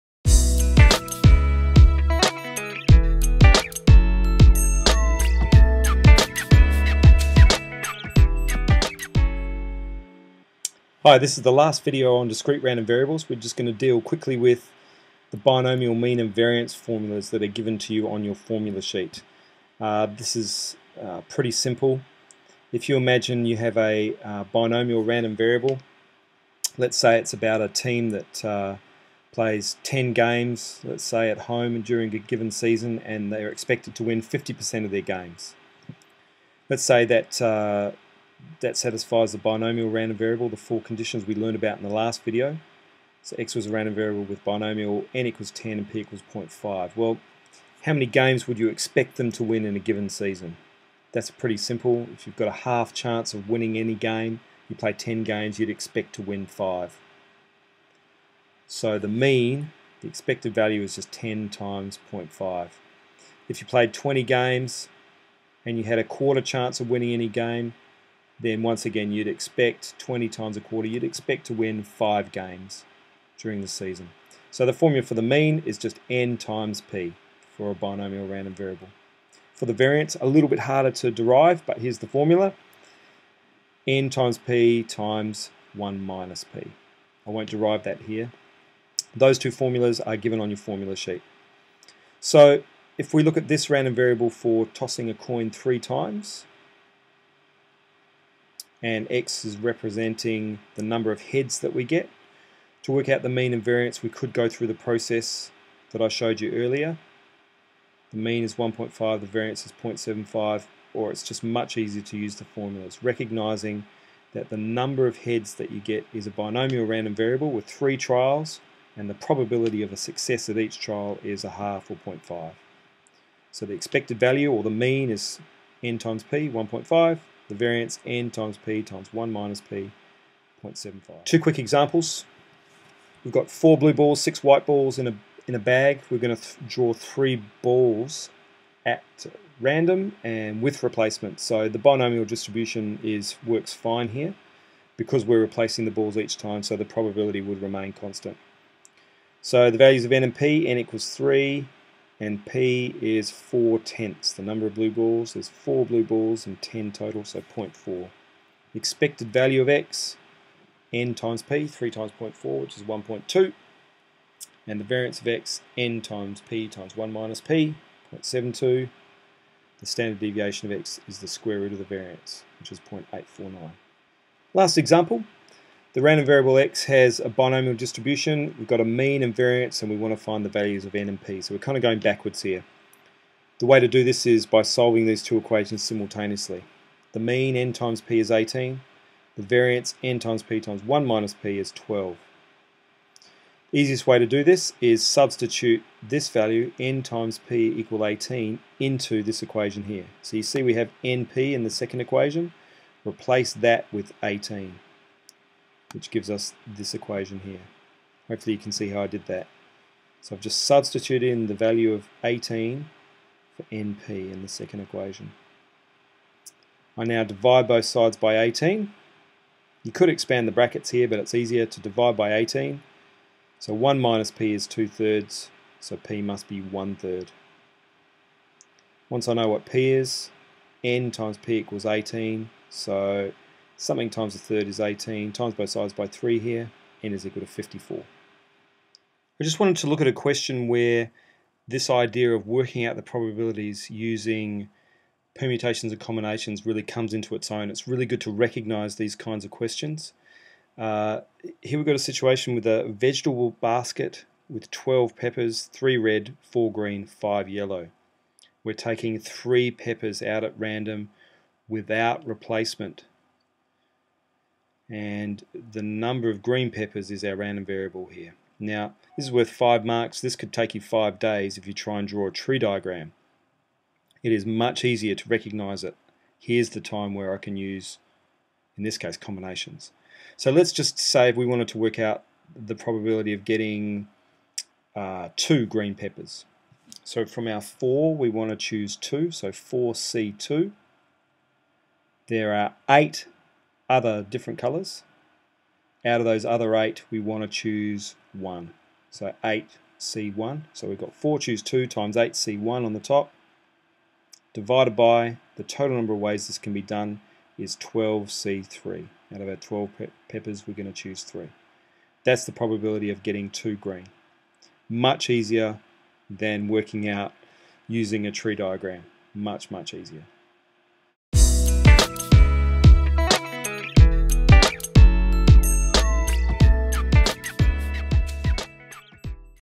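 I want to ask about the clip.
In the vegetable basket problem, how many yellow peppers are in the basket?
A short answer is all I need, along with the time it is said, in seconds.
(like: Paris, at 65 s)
5, at 257 s.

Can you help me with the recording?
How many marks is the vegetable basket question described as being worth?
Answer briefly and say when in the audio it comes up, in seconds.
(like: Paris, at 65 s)
5, at 269 s.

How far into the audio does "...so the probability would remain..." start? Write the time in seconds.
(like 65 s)
146 s.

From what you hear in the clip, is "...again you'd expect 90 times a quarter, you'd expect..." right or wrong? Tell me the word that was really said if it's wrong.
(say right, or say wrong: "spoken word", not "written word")
wrong: "20", not "90".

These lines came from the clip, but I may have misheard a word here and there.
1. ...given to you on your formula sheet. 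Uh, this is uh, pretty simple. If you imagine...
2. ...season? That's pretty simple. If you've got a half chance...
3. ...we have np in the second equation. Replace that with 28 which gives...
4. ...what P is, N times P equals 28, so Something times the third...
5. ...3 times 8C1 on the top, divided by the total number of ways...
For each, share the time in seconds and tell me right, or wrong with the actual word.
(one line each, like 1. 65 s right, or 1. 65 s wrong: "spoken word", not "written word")
1. 17 s right
2. 50 s right
3. 200 s wrong: "18", not "28"
4. 229 s wrong: "18", not "28"
5. 301 s wrong: "2", not "3".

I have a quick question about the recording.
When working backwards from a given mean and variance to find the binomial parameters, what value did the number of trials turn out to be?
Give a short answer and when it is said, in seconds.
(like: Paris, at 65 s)
54, at 237 s.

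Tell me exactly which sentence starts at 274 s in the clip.
It is much easier to recognize it.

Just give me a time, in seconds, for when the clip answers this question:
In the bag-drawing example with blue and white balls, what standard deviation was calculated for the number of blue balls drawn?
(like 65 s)
172 s.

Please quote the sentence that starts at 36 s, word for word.
Let's say that uh, that satisfies the binomial random variable, the four conditions we learned about in the last video.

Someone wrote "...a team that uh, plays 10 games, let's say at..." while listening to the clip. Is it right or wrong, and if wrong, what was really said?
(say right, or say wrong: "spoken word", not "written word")
right.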